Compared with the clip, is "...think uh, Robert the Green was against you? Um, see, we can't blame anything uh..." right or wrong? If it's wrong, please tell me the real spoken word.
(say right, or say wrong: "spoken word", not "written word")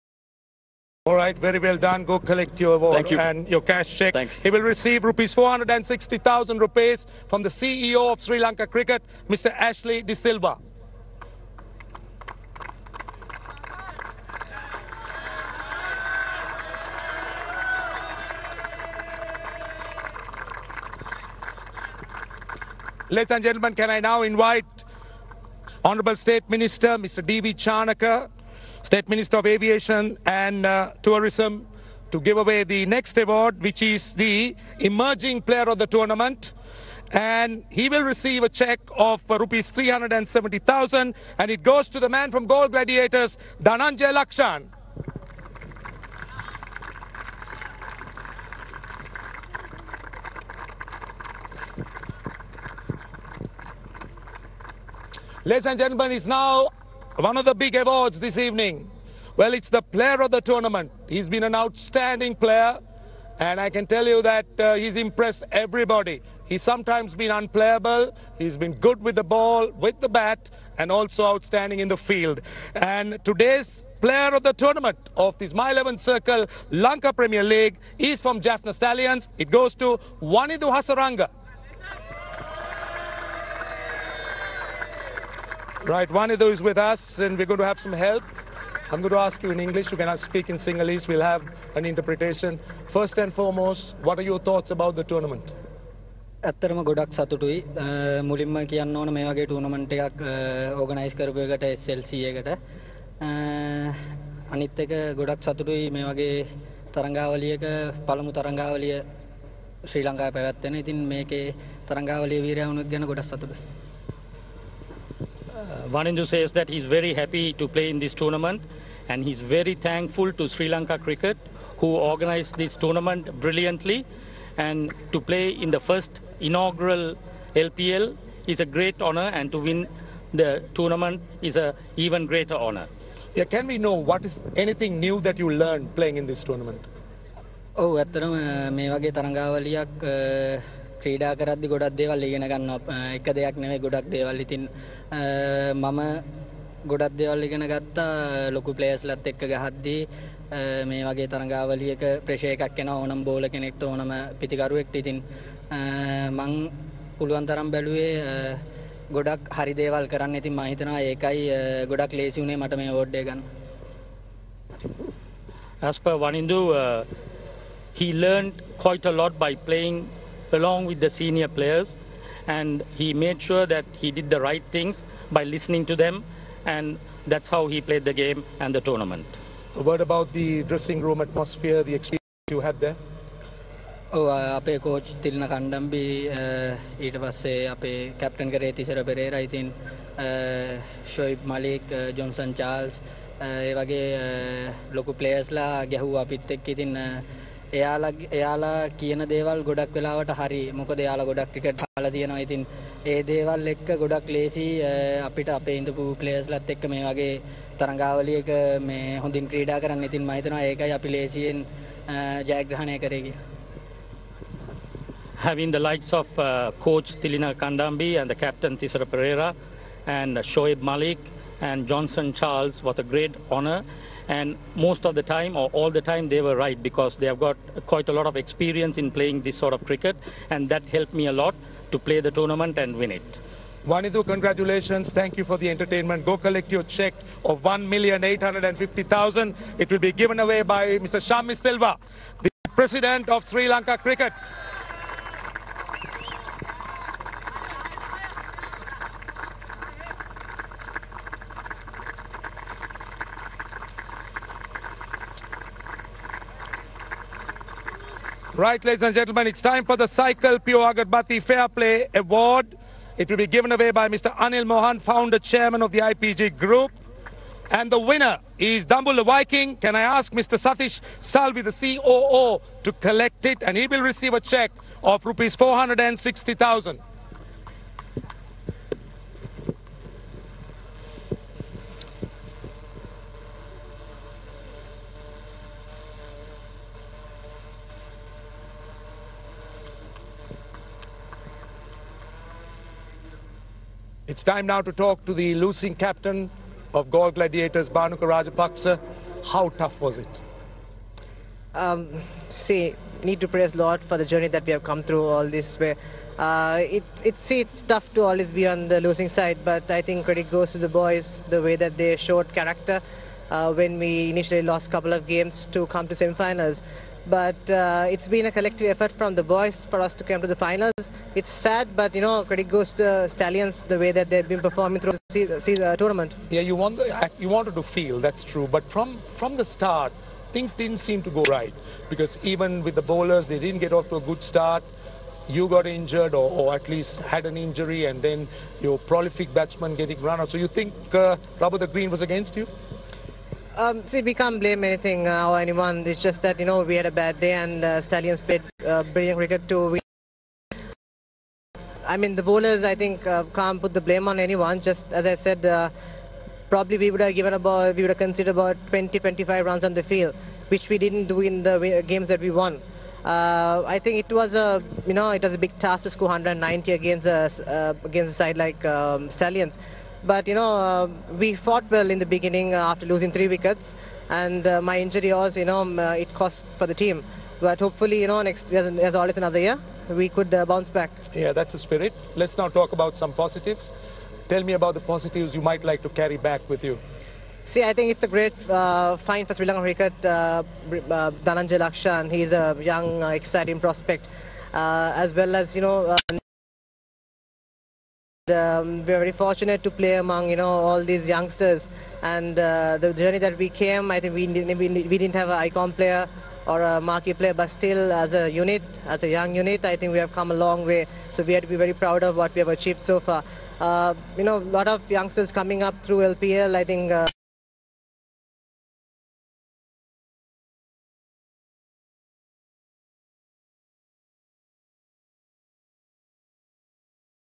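right.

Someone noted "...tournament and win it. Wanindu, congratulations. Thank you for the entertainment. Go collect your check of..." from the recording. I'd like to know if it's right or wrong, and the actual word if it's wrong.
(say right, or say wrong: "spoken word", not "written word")
right.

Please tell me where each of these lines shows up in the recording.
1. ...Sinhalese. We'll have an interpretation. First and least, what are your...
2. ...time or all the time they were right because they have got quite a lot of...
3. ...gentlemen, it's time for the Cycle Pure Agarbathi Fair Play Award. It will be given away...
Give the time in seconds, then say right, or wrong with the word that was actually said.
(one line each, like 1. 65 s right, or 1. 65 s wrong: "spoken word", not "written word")
1. 90 s wrong: "foremost", not "least"
2. 225 s right
3. 259 s right.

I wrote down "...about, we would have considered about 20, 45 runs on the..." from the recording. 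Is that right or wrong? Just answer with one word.
wrong.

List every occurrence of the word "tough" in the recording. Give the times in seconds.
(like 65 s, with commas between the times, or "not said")
299 s, 307 s.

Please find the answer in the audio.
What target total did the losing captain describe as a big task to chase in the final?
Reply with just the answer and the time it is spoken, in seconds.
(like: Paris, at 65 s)
190, at 366 s.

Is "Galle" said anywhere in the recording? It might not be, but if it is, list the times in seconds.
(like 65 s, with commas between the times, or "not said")
42 s, 297 s.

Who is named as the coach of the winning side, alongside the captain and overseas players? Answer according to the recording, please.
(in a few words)
Tilina Kandambi.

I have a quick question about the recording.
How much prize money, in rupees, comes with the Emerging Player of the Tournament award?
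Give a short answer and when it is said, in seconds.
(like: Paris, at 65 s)
370,000, at 39 s.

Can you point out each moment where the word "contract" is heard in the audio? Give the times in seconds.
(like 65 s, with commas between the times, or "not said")
not said.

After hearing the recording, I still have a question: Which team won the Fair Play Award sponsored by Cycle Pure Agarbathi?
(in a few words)
Dambulla Viiking.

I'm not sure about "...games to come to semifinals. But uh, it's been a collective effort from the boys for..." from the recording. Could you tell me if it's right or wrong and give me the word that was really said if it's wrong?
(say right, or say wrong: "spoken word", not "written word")
right.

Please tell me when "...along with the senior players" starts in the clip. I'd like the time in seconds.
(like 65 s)
170 s.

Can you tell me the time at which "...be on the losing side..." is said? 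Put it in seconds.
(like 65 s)
308 s.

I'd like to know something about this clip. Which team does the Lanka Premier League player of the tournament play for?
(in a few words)
Jaffna Stallions.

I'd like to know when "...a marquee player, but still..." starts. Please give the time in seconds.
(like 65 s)
406 s.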